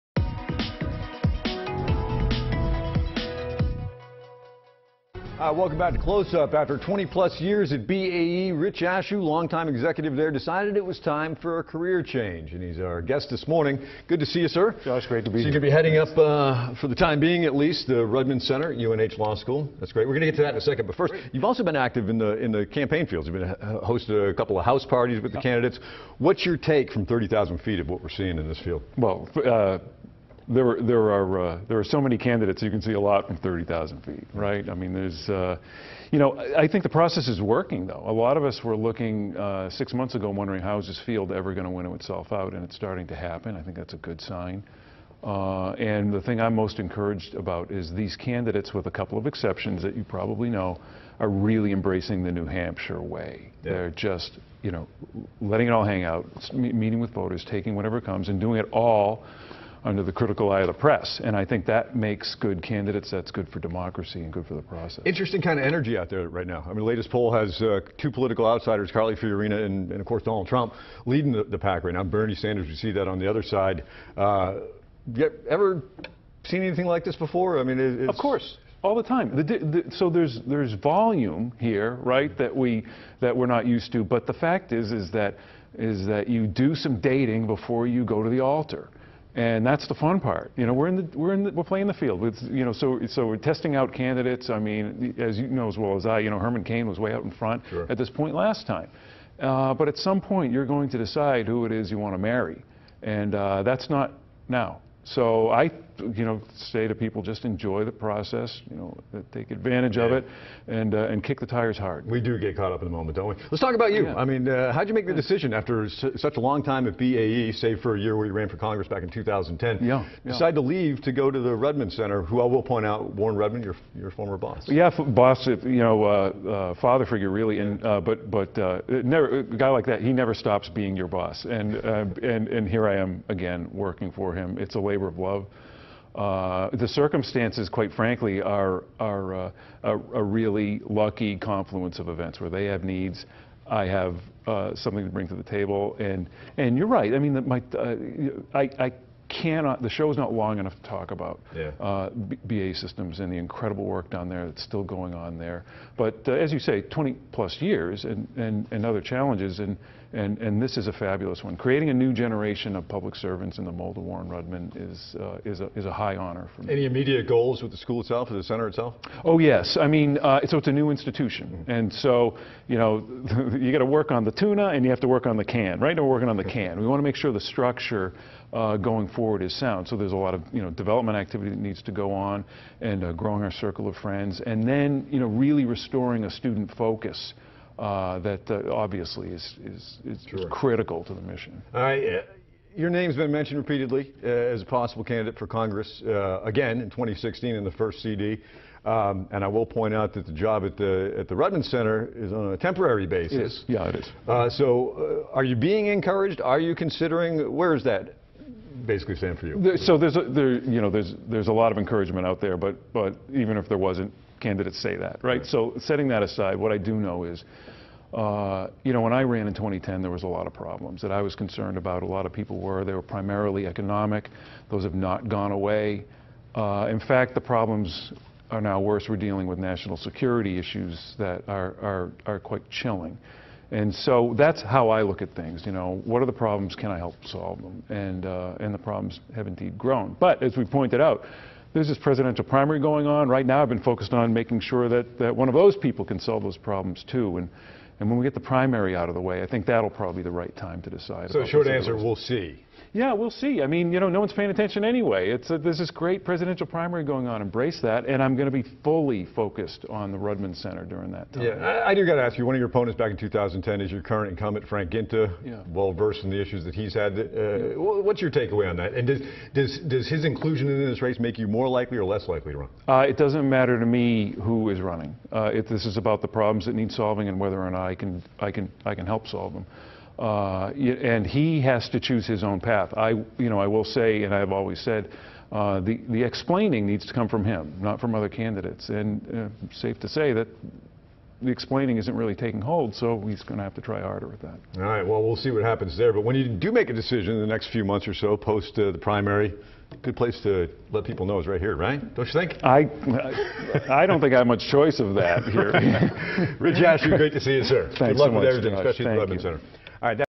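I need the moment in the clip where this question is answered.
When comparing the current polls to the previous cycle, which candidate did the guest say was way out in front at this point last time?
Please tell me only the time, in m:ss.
1:36.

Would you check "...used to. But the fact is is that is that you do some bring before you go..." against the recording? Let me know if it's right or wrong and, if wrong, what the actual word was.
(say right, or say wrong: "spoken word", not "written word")
wrong: "dating", not "bring".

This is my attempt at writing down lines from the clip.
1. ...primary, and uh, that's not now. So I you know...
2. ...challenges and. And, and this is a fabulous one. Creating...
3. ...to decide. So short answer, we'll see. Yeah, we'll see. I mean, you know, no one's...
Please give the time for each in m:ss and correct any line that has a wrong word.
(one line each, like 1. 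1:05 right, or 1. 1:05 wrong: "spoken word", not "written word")
1. 1:42 wrong: "marry", not "primary"
2. 2:39 right
3. 4:10 right.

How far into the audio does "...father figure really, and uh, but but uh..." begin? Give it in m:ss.
2:06.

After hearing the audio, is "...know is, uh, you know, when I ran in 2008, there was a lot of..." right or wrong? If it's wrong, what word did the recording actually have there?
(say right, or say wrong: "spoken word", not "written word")
wrong: "2010", not "2008".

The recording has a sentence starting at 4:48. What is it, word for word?
And uh, safe to say that the explaining isn't really taking hold, so he's going to have to try harder with that.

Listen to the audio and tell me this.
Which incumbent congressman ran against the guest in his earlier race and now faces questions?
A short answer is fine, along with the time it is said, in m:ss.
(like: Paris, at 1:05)
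Frank Guinta, at 4:24.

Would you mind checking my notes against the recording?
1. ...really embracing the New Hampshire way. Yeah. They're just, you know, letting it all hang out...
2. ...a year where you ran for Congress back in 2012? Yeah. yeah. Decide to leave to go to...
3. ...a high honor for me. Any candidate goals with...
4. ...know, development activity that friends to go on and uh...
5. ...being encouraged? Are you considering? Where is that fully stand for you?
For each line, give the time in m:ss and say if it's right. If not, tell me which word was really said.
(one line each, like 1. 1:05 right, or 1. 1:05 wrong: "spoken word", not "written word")
1. 0:51 right
2. 1:57 wrong: "2010", not "2012"
3. 2:45 wrong: "immediate", not "candidate"
4. 3:00 wrong: "needs", not "friends"
5. 3:25 wrong: "basically", not "fully".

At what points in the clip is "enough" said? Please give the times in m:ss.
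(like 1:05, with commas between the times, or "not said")
2:30.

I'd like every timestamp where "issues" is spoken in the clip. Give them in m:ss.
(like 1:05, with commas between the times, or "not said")
3:50, 4:26.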